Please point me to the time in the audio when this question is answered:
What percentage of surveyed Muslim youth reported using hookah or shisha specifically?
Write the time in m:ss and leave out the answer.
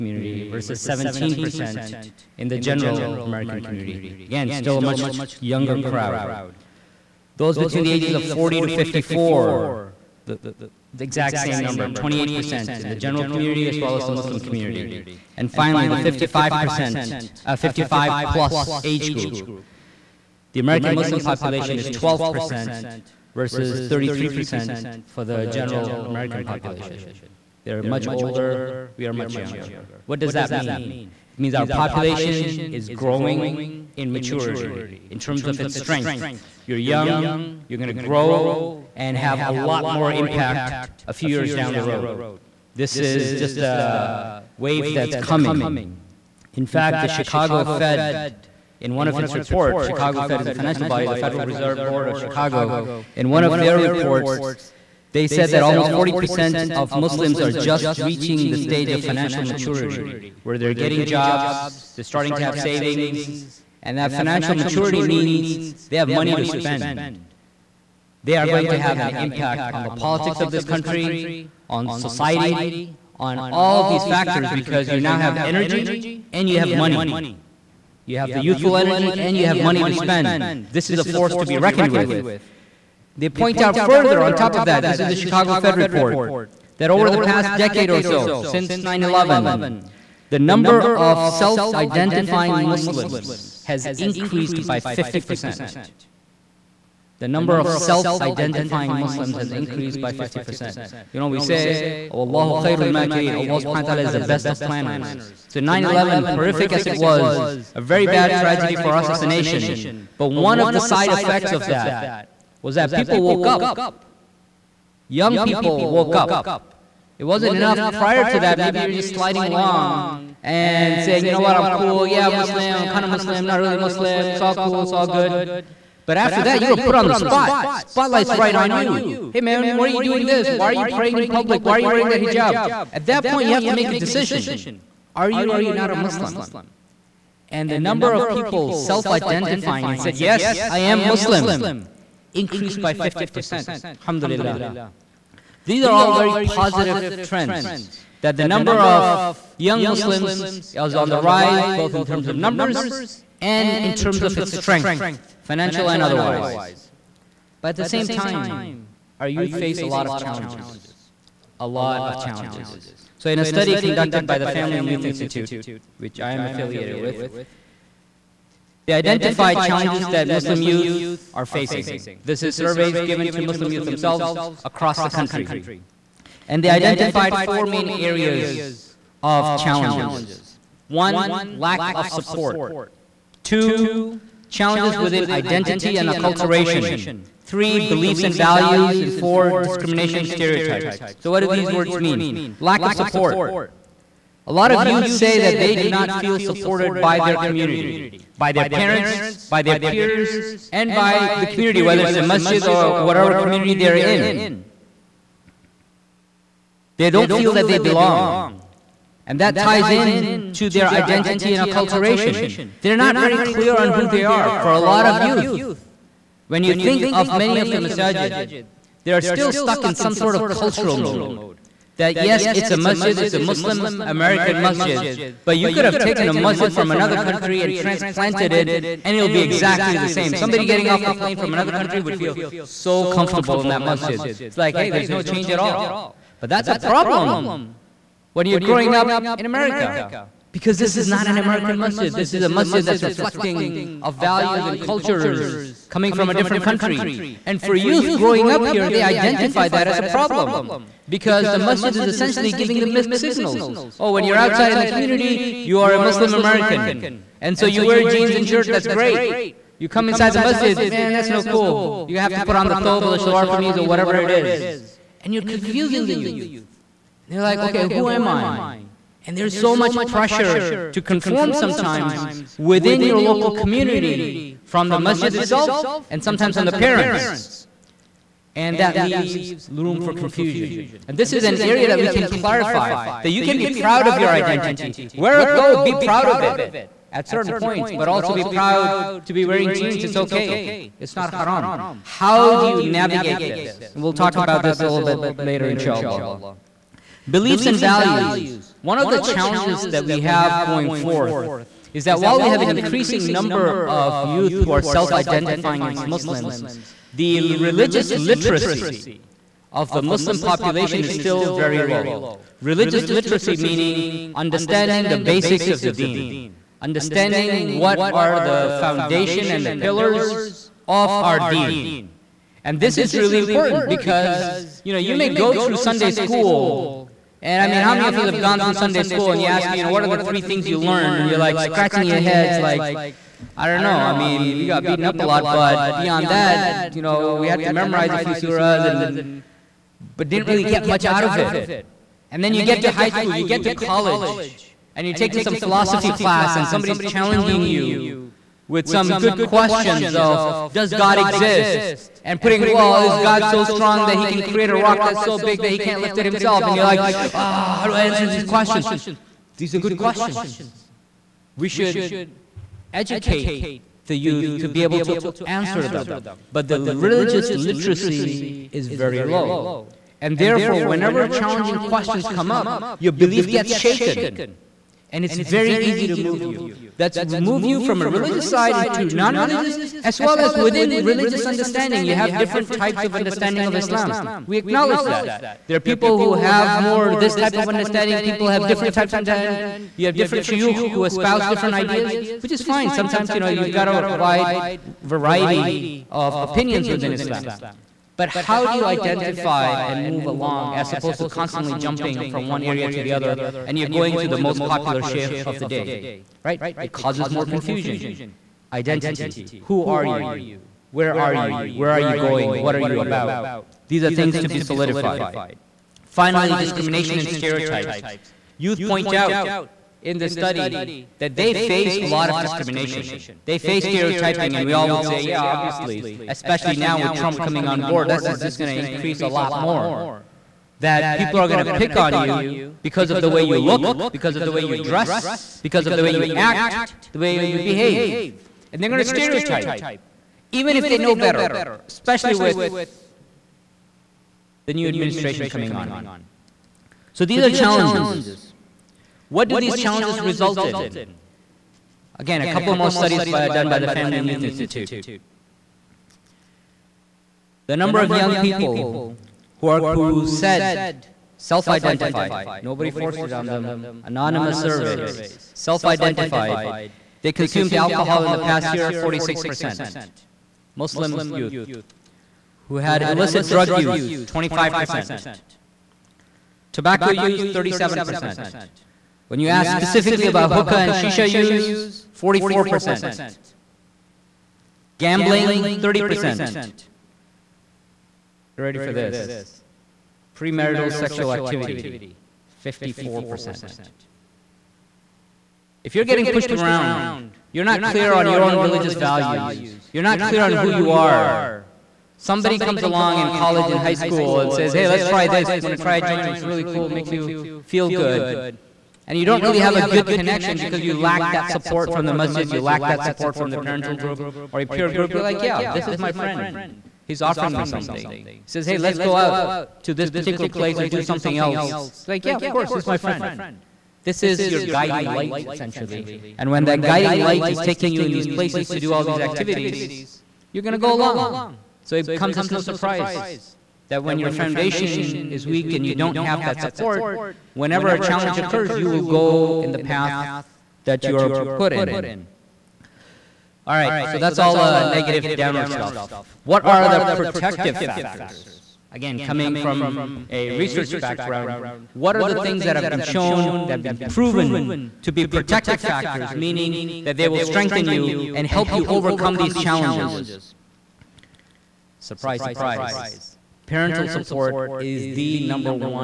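8:02.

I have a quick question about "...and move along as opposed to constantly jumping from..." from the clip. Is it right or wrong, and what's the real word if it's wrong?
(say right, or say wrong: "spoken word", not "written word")
right.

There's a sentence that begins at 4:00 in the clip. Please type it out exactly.
Because this is not an American masjid.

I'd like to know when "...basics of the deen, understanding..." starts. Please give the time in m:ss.
5:15.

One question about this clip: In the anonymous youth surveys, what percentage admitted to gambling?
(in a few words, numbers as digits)
30%.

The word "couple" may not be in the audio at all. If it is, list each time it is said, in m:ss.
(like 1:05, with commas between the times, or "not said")
7:32.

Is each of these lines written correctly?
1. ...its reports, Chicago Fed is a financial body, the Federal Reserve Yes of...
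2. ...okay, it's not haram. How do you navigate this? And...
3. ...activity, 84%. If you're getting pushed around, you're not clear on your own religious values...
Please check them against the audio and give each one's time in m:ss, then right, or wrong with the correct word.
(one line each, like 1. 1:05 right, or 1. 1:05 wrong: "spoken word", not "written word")
1. 0:49 wrong: "Board", not "Yes"
2. 4:50 right
3. 8:11 wrong: "54", not "84".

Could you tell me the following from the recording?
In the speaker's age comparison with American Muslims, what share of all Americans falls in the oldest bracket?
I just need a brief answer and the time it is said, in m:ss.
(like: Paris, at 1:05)
33%, at 0:23.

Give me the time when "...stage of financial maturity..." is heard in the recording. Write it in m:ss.
0:58.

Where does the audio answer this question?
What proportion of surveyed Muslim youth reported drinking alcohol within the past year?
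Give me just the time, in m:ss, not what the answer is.
7:48.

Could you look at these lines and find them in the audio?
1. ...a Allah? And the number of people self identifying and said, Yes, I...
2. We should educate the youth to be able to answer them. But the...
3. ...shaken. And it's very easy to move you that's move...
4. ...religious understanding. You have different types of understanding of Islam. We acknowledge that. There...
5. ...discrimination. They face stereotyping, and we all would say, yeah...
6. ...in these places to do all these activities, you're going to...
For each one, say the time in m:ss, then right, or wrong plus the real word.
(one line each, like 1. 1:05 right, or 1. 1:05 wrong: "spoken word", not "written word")
1. 2:15 wrong: "Muslim", not "Allah"
2. 6:01 right
3. 6:13 right
4. 6:21 right
5. 7:02 right
6. 8:48 right.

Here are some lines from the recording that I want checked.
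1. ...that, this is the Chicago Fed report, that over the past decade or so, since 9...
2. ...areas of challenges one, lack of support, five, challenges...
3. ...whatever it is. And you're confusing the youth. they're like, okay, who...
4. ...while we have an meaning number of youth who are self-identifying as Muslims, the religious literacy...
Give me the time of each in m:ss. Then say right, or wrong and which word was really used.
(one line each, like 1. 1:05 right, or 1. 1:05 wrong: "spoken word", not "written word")
1. 1:24 right
2. 2:57 wrong: "two", not "five"
3. 4:23 right
4. 5:02 wrong: "increasing", not "meaning".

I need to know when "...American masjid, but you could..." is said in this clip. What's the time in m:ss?
3:44.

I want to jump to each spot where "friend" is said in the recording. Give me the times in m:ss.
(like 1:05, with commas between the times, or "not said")
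8:36, 8:42.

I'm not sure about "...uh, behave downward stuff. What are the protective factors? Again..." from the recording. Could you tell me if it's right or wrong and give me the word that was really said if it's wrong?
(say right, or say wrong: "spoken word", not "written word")
wrong: "negative", not "behave".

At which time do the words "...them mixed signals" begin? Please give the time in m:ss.
4:12.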